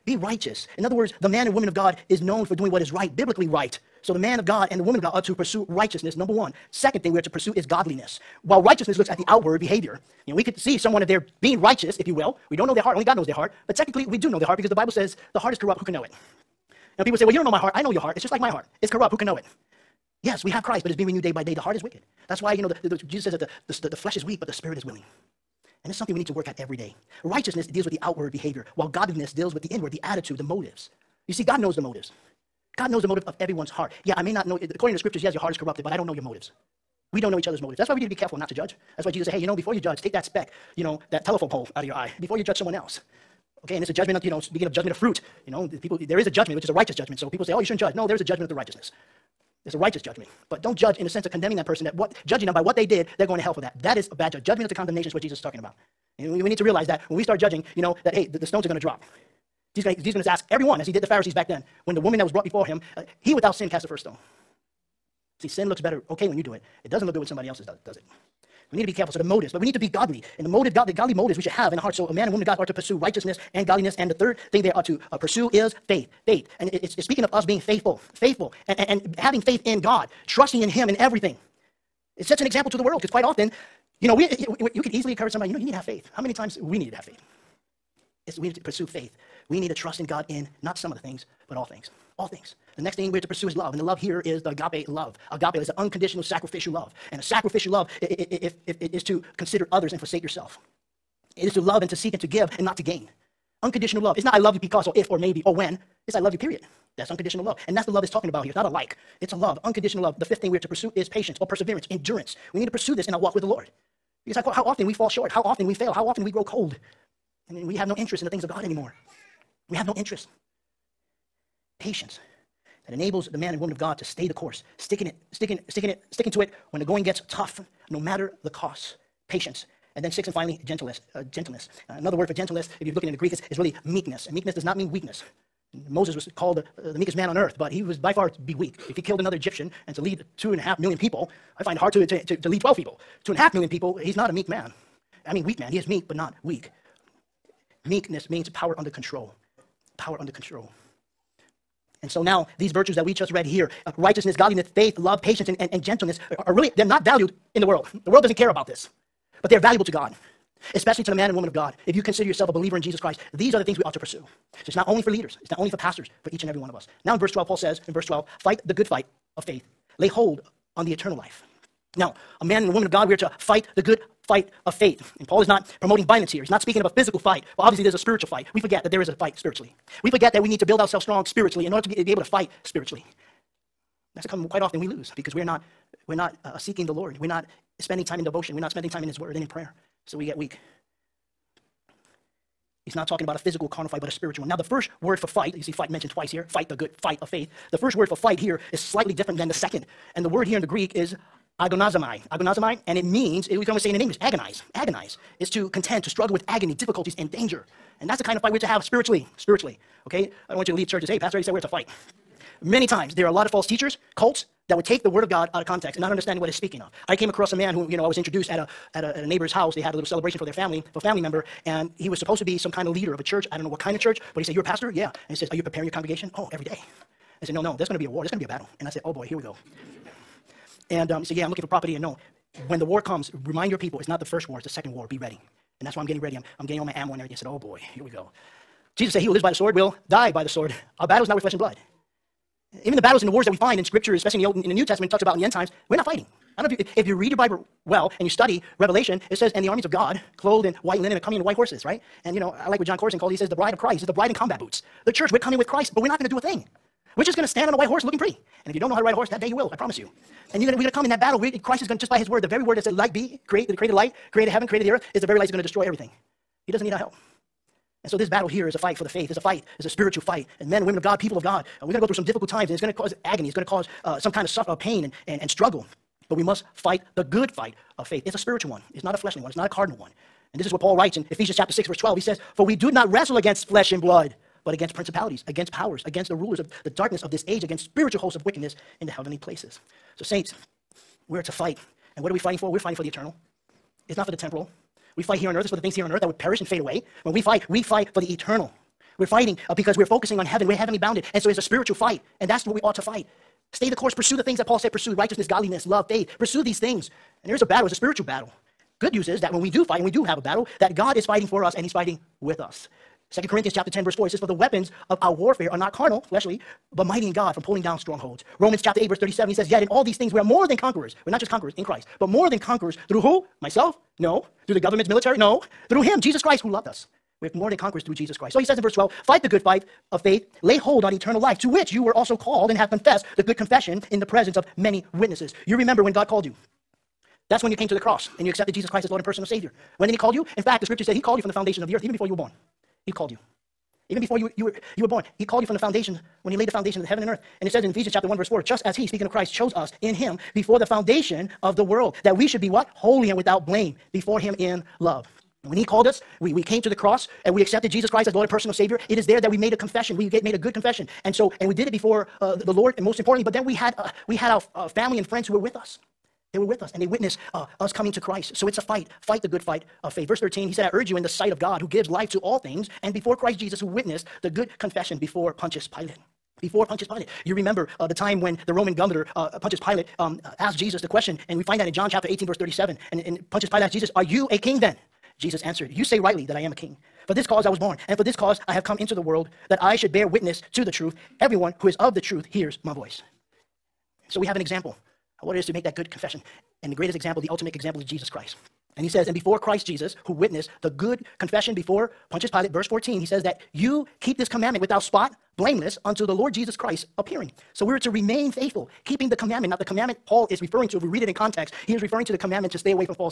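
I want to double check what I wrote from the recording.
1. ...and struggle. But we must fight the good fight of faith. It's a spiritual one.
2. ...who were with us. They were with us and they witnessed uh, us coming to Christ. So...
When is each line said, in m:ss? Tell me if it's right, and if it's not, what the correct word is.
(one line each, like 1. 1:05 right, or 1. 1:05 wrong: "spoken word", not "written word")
1. 4:35 right
2. 6:05 right.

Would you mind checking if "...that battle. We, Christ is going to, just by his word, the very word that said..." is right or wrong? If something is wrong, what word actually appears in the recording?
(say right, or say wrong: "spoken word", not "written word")
right.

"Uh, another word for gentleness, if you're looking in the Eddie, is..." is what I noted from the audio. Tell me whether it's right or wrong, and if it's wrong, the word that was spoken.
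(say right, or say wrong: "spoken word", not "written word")
wrong: "Greek", not "Eddie".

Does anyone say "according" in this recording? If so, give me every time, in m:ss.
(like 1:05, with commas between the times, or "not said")
0:34.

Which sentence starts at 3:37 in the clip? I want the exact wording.
I came across a man who, you know, I was introduced at a at a, at a neighbor's house.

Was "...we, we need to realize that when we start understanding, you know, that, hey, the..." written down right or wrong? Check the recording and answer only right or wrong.
wrong.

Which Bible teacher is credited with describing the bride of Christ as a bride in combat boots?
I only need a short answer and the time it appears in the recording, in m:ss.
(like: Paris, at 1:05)
Jon Courson, at 4:12.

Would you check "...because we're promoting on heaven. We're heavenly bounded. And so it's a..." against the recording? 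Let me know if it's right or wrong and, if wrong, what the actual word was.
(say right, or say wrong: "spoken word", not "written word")
wrong: "focusing", not "promoting".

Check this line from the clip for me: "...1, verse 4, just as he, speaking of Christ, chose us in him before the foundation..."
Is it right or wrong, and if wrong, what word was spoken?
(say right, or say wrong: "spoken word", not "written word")
right.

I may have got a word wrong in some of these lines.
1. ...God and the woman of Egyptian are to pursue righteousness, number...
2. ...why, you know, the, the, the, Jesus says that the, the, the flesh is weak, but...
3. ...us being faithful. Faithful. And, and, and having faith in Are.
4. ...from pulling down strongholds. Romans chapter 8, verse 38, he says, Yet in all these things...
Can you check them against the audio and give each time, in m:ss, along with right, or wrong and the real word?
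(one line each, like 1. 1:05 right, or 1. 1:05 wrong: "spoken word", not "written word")
1. 0:04 wrong: "God", not "Egyptian"
2. 0:22 right
3. 1:17 wrong: "God", not "Are"
4. 5:17 wrong: "37", not "38".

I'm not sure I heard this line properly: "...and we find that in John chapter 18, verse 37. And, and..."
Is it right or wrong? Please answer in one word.
right.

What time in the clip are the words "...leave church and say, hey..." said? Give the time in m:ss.
3:30.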